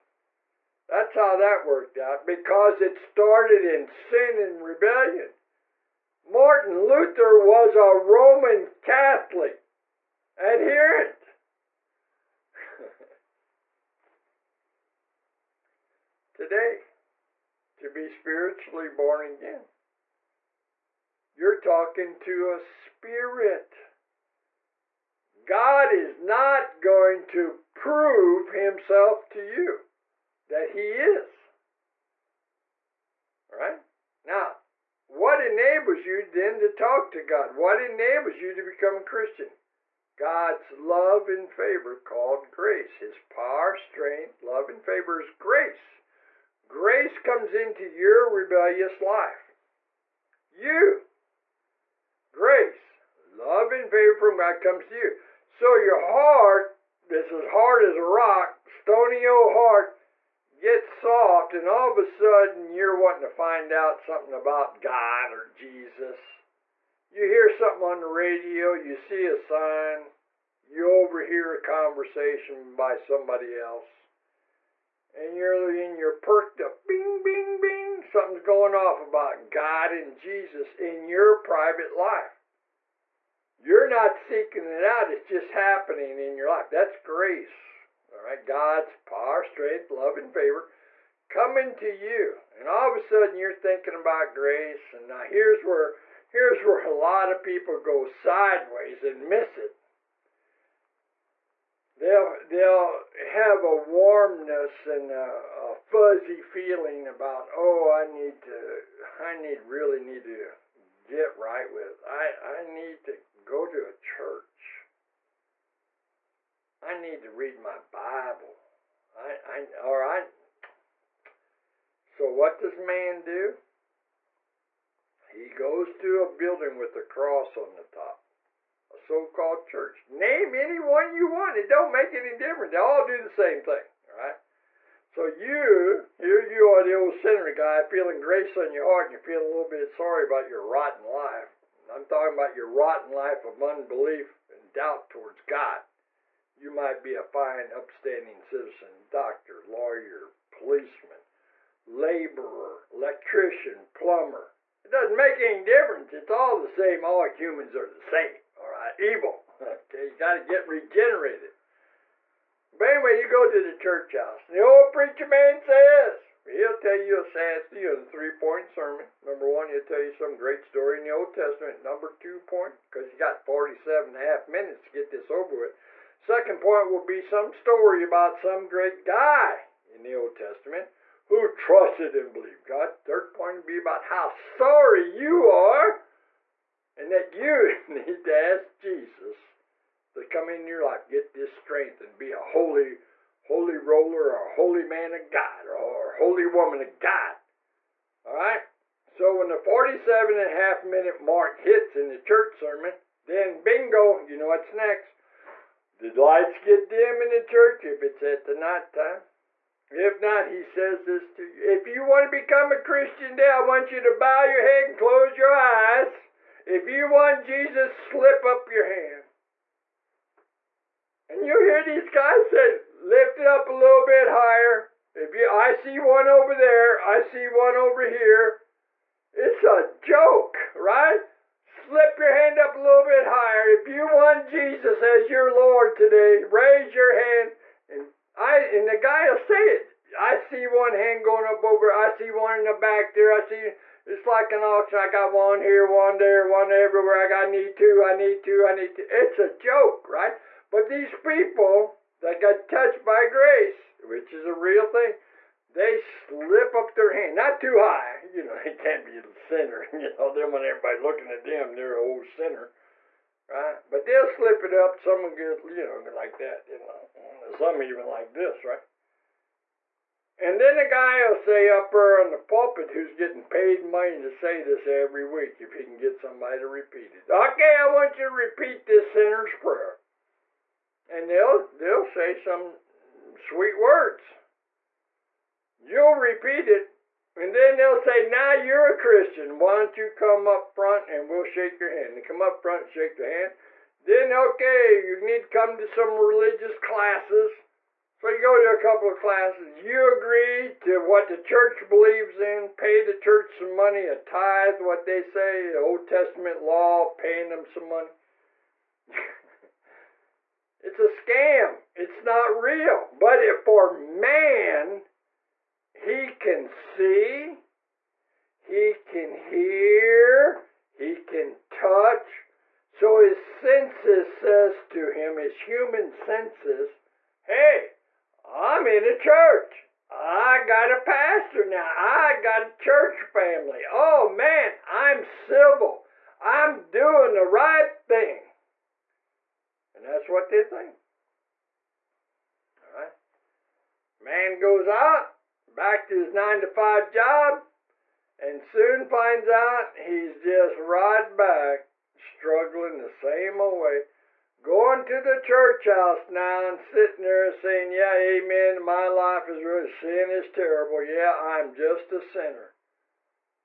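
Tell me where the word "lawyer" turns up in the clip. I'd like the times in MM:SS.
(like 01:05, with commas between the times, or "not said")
02:29.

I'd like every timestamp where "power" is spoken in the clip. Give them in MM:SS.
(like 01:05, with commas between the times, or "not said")
00:43, 01:28.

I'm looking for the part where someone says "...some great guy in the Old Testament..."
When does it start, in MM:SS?
02:58.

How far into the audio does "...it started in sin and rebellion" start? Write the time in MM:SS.
00:02.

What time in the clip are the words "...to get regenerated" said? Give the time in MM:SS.
02:40.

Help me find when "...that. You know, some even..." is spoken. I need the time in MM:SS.
04:26.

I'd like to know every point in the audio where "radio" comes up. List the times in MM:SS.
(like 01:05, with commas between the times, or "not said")
01:08.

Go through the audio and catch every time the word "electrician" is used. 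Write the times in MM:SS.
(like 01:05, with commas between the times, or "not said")
02:32.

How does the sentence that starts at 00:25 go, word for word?
God is not going to prove himself to you that he is.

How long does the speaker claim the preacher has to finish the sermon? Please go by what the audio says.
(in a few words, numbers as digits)
47 and a half minutes.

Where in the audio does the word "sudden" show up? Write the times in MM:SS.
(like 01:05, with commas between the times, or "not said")
01:02, 01:32.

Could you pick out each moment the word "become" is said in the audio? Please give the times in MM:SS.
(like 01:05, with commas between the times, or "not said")
00:38, 03:32.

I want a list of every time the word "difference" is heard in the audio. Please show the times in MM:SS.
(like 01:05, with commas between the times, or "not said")
02:12, 02:35.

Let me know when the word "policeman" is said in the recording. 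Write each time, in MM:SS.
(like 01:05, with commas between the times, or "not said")
02:30.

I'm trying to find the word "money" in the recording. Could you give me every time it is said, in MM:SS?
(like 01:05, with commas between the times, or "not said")
04:33, 05:03, 05:07.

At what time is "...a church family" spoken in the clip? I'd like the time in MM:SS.
05:32.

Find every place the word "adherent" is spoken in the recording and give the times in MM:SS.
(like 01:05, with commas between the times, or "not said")
00:10.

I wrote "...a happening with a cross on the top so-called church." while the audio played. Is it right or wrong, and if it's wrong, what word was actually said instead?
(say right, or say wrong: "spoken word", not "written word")
wrong: "building", not "happening".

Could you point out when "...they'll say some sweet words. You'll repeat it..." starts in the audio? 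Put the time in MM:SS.
04:41.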